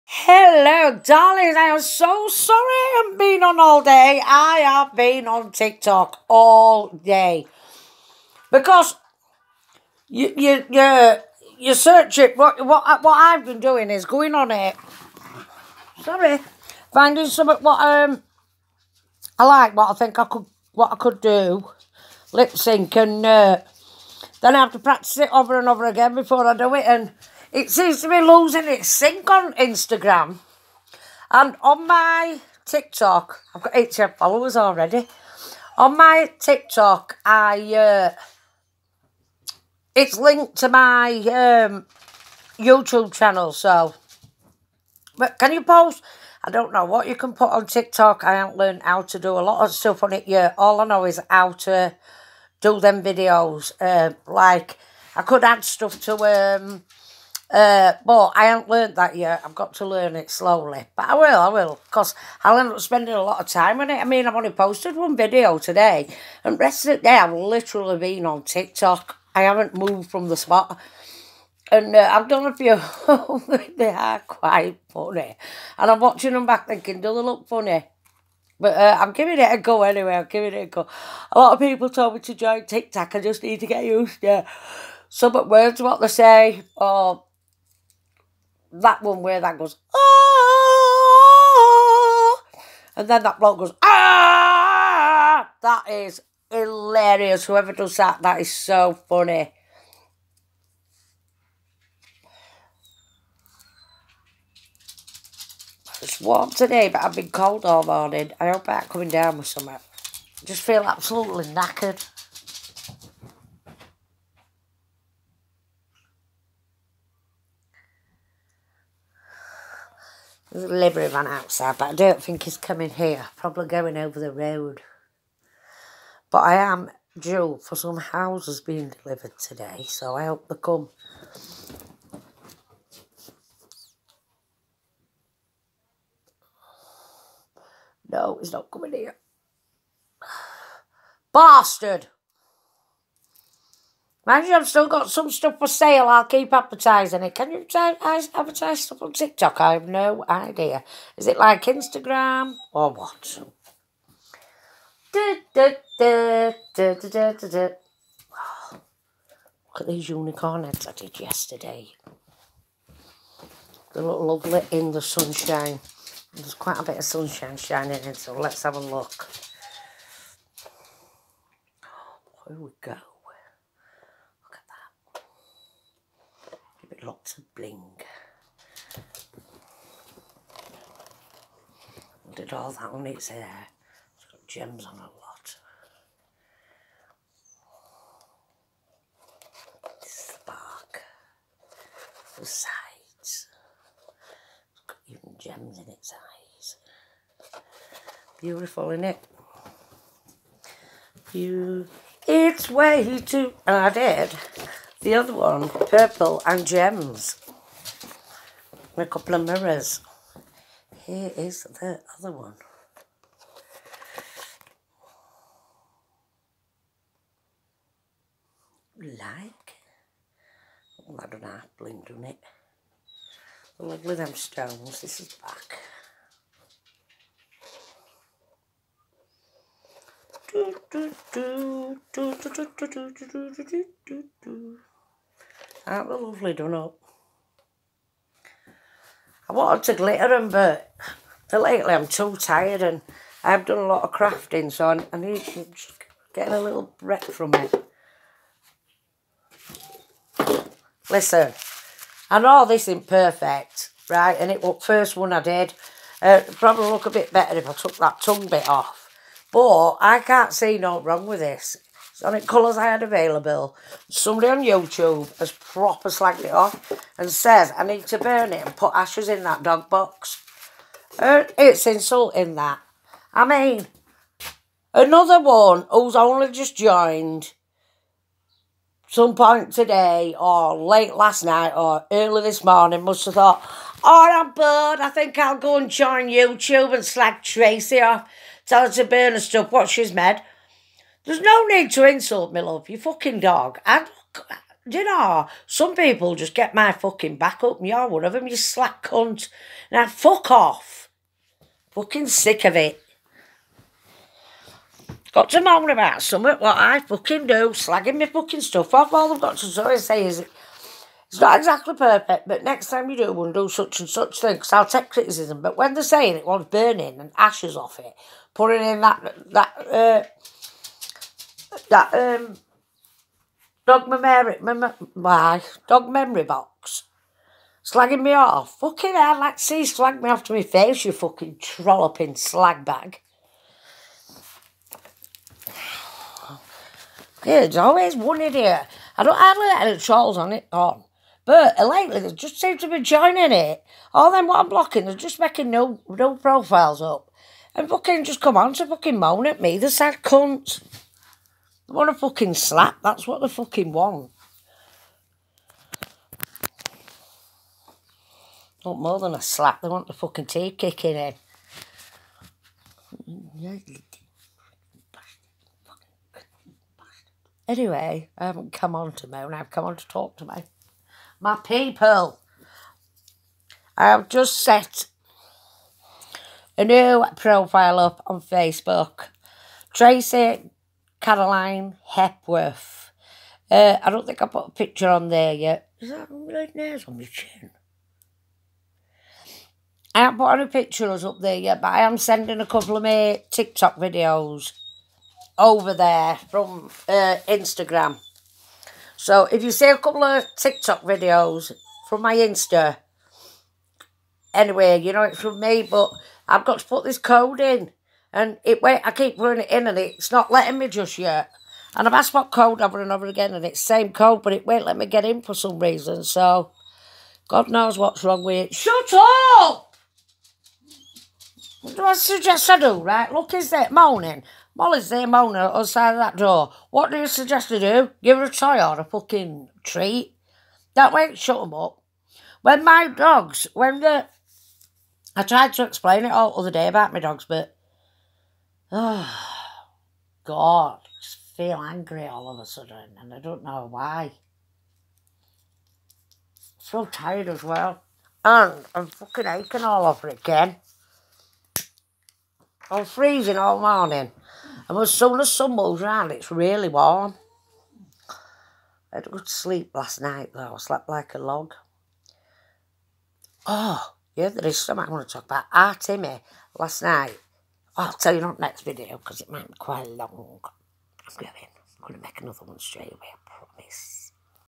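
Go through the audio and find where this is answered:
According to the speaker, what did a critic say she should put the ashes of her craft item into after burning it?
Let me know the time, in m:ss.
4:29.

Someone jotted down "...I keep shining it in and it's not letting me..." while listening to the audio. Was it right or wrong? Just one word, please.
wrong.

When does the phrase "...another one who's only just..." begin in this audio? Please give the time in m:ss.
4:34.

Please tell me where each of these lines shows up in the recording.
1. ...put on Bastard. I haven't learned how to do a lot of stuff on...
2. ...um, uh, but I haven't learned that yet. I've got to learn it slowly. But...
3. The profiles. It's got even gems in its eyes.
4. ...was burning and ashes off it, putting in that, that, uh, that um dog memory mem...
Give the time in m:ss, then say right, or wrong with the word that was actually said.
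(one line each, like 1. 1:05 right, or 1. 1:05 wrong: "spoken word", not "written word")
1. 0:47 wrong: "TikTok", not "Bastard"
2. 0:56 right
3. 3:12 wrong: "sides", not "profiles"
4. 5:16 right.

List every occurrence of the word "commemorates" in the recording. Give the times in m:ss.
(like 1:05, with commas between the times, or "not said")
not said.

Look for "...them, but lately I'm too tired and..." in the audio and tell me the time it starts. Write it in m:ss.
4:00.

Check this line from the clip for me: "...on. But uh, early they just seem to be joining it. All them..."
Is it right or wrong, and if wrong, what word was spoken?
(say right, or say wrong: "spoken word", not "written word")
wrong: "lately", not "early".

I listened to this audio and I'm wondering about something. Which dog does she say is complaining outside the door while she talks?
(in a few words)
Molly.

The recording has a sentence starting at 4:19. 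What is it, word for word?
But I can't see no wrong with this it colours I had available.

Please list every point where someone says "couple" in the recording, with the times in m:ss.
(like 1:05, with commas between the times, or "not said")
3:29, 6:32, 6:39.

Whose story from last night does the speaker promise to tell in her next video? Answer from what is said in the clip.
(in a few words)
Timmy.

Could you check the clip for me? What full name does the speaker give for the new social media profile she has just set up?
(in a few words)
Tracy Caroline Hepworth.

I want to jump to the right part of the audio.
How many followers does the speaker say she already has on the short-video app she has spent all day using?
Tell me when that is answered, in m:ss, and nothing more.
0:33.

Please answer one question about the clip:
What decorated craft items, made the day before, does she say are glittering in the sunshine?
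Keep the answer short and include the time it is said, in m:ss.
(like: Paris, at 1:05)
unicorn eggs, at 2:40.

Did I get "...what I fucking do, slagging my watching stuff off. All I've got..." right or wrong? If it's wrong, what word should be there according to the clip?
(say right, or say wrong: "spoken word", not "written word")
wrong: "fucking", not "watching".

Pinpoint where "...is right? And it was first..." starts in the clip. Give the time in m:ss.
4:12.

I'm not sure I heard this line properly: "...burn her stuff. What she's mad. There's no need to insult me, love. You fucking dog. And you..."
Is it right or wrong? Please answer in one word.
right.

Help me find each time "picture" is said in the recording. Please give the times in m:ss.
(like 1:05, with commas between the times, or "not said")
6:24, 6:30.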